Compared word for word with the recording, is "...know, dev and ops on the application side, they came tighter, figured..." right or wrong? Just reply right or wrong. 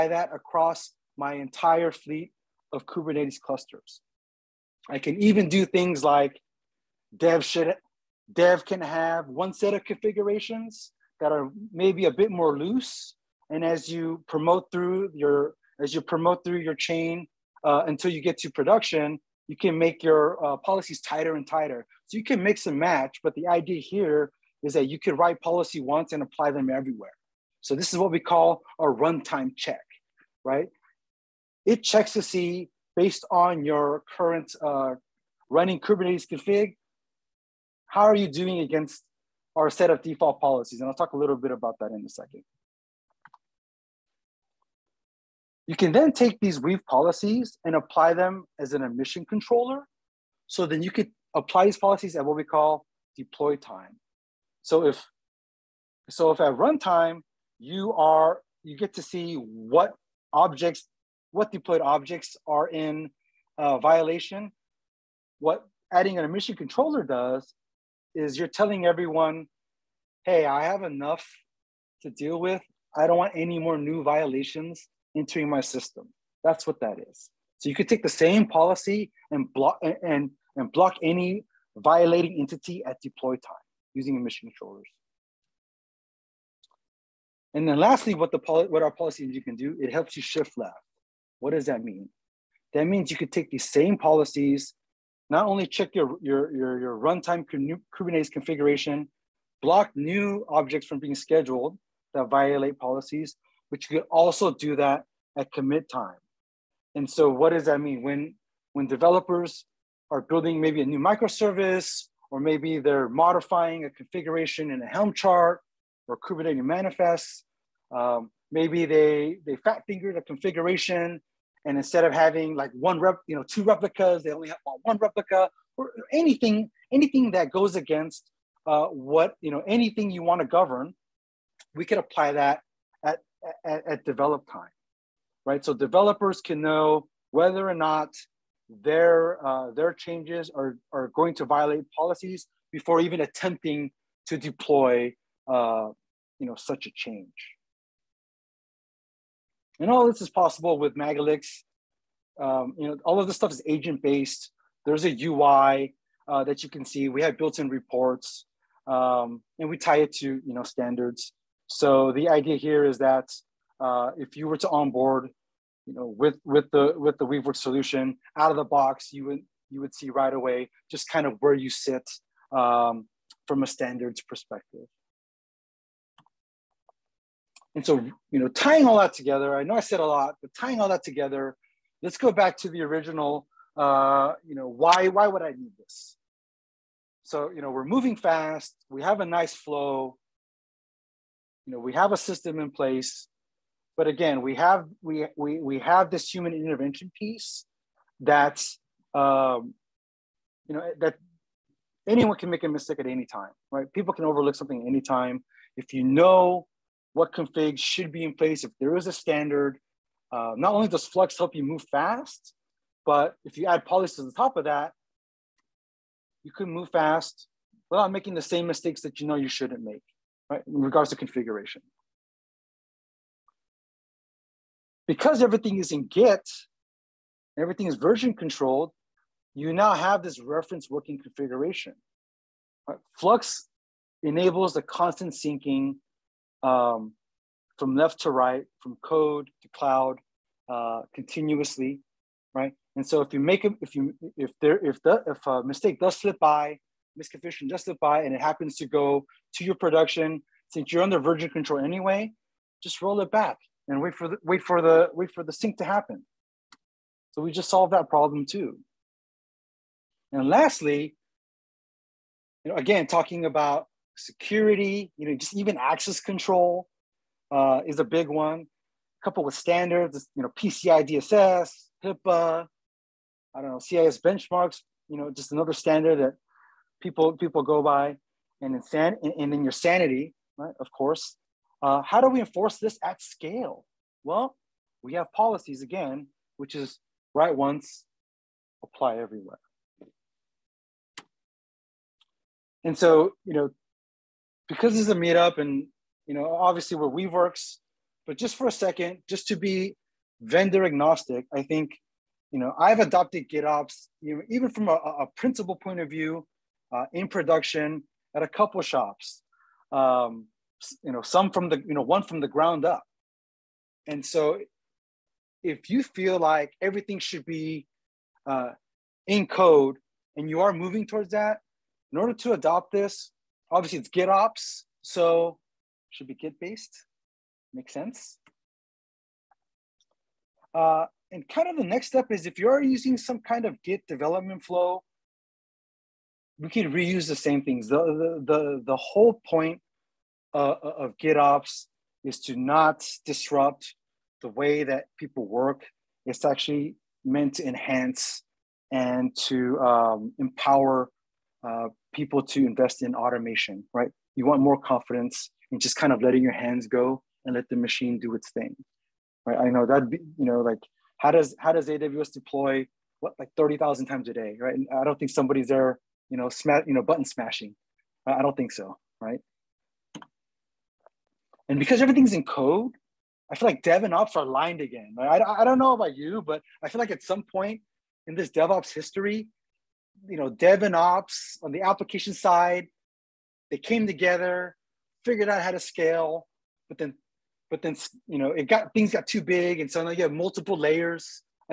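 wrong.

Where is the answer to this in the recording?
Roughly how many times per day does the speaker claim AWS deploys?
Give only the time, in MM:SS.
06:03.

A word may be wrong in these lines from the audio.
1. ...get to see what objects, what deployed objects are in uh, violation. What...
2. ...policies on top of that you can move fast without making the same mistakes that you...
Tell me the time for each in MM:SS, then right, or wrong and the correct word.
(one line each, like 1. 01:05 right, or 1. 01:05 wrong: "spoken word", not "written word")
1. 00:58 right
2. 03:33 right.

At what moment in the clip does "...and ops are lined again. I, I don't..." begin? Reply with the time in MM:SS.
06:14.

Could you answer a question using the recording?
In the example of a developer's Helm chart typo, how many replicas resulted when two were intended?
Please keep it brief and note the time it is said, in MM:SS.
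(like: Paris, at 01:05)
1, at 02:04.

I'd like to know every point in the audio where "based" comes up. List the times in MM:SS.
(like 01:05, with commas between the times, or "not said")
00:32, 02:34, 05:26.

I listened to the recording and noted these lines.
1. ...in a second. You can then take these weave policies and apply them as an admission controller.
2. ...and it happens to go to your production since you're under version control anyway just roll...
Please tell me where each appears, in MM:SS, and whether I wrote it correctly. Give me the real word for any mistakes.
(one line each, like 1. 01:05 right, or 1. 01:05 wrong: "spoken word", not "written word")
1. 00:41 right
2. 04:08 right.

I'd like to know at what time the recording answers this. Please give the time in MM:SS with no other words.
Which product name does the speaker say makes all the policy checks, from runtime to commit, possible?
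02:30.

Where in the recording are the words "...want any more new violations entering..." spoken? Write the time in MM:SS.
01:13.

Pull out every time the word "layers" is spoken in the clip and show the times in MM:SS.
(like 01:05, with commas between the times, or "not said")
06:30.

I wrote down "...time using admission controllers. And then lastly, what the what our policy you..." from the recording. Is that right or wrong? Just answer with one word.
right.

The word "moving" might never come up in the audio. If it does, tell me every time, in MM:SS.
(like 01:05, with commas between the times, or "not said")
03:07, 05:20.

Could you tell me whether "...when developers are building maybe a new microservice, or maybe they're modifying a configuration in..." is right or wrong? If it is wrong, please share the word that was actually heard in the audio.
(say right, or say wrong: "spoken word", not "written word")
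right.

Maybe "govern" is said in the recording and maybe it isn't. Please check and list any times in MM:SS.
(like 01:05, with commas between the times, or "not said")
02:10.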